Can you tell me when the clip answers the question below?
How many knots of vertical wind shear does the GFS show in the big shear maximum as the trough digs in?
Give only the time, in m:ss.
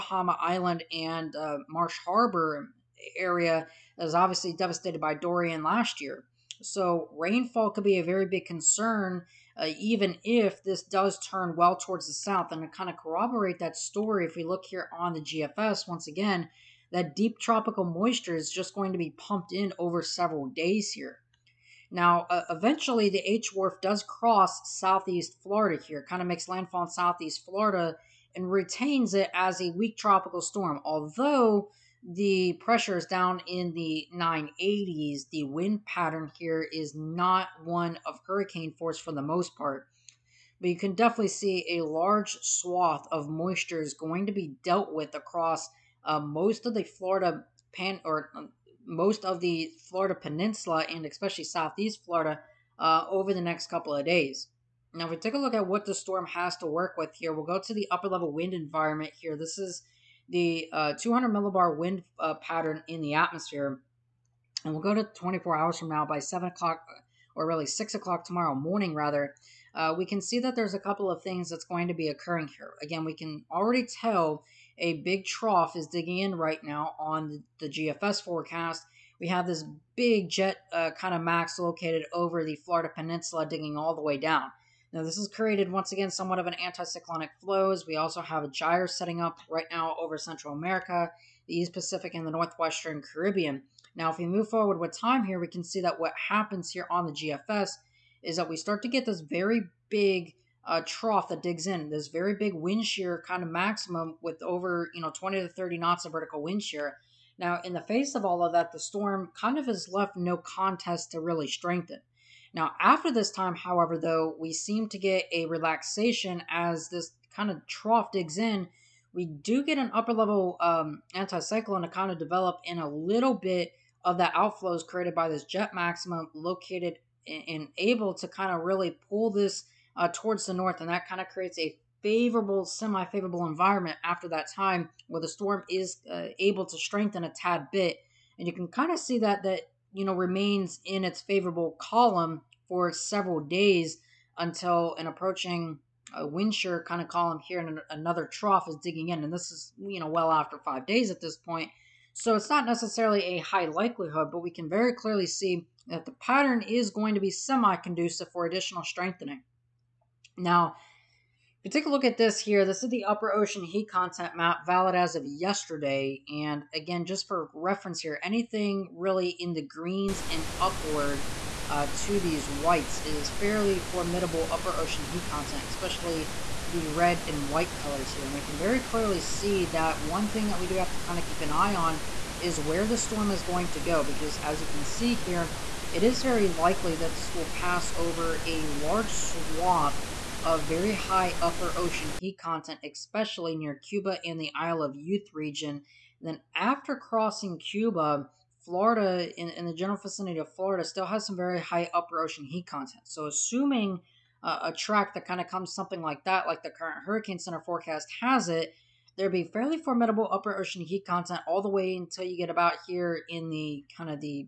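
1:45.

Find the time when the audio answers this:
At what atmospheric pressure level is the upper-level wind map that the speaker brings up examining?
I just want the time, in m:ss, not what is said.
1:00.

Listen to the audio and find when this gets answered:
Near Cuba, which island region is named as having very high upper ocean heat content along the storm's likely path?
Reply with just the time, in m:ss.
3:14.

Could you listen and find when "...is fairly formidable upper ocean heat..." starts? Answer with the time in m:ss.
2:53.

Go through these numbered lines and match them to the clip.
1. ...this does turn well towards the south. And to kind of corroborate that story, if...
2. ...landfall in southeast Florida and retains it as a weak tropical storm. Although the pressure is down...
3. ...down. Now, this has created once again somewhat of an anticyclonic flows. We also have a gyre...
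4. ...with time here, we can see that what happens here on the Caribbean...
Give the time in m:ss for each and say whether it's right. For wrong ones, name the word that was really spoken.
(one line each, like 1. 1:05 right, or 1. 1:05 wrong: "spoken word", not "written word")
1. 0:10 right
2. 0:26 right
3. 1:24 right
4. 1:34 wrong: "GFS", not "Caribbean".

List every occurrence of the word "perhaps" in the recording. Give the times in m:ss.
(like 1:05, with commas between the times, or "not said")
not said.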